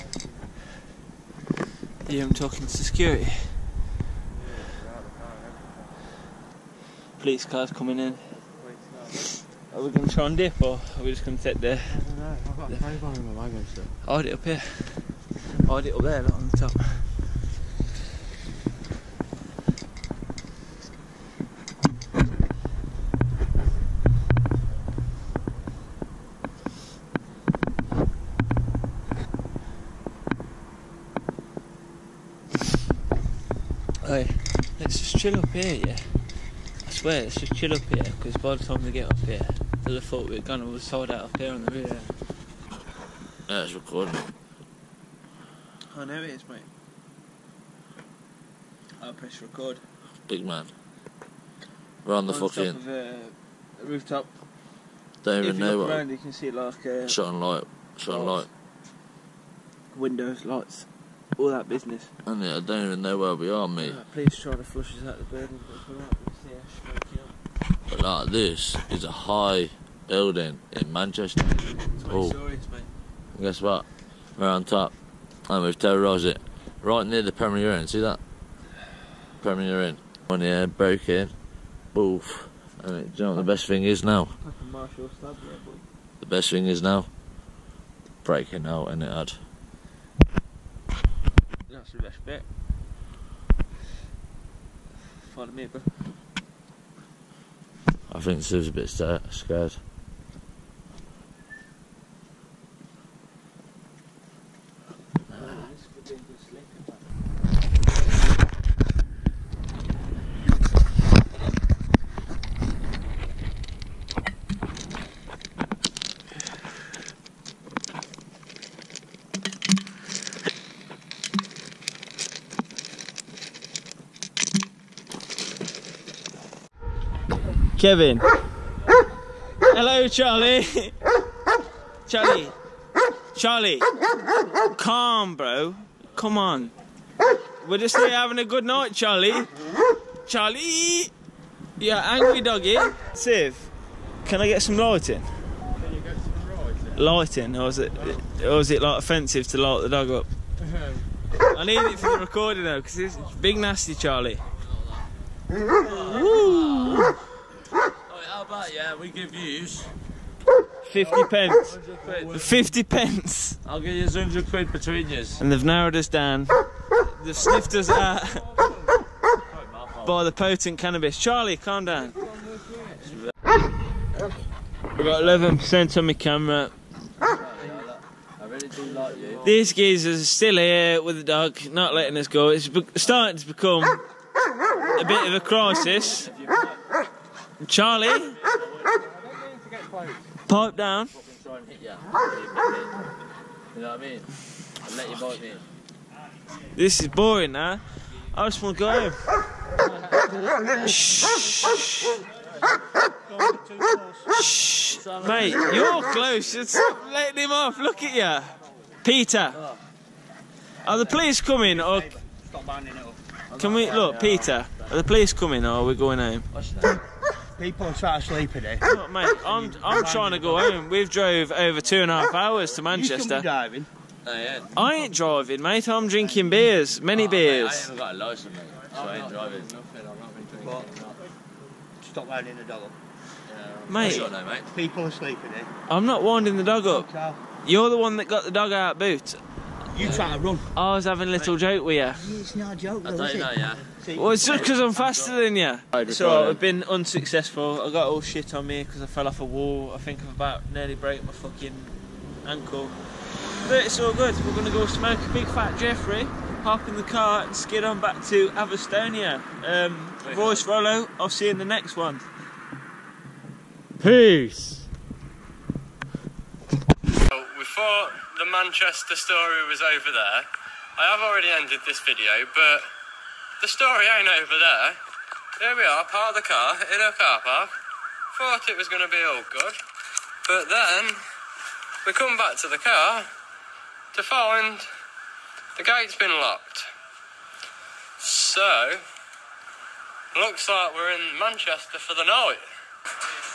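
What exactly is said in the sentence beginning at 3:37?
People try to sleep in it.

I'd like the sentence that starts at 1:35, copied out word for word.
Pardon me, but I think Sue's a bit scared.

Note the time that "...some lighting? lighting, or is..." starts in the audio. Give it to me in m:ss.
2:24.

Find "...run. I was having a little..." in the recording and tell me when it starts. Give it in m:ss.
4:00.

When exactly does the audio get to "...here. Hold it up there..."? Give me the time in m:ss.
0:14.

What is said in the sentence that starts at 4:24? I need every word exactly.
Peace before the Manchester story was over there, I have already ended this video, but the story ain't over there.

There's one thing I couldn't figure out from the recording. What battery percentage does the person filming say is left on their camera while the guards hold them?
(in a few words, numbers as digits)
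11%.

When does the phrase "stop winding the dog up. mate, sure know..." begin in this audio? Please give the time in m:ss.
3:52.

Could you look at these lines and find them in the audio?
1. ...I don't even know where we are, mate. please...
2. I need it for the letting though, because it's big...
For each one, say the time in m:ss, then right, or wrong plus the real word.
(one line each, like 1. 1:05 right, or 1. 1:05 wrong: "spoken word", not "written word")
1. 1:02 right
2. 2:31 wrong: "recording", not "letting".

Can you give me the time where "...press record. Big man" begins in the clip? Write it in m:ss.
0:49.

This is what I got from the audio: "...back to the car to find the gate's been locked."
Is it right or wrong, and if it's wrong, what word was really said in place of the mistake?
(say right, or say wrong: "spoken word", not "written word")
right.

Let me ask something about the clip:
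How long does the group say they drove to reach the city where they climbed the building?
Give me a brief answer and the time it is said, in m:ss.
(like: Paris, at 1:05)
Two and a half hours, at 3:41.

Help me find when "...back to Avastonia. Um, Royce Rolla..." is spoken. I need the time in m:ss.
4:18.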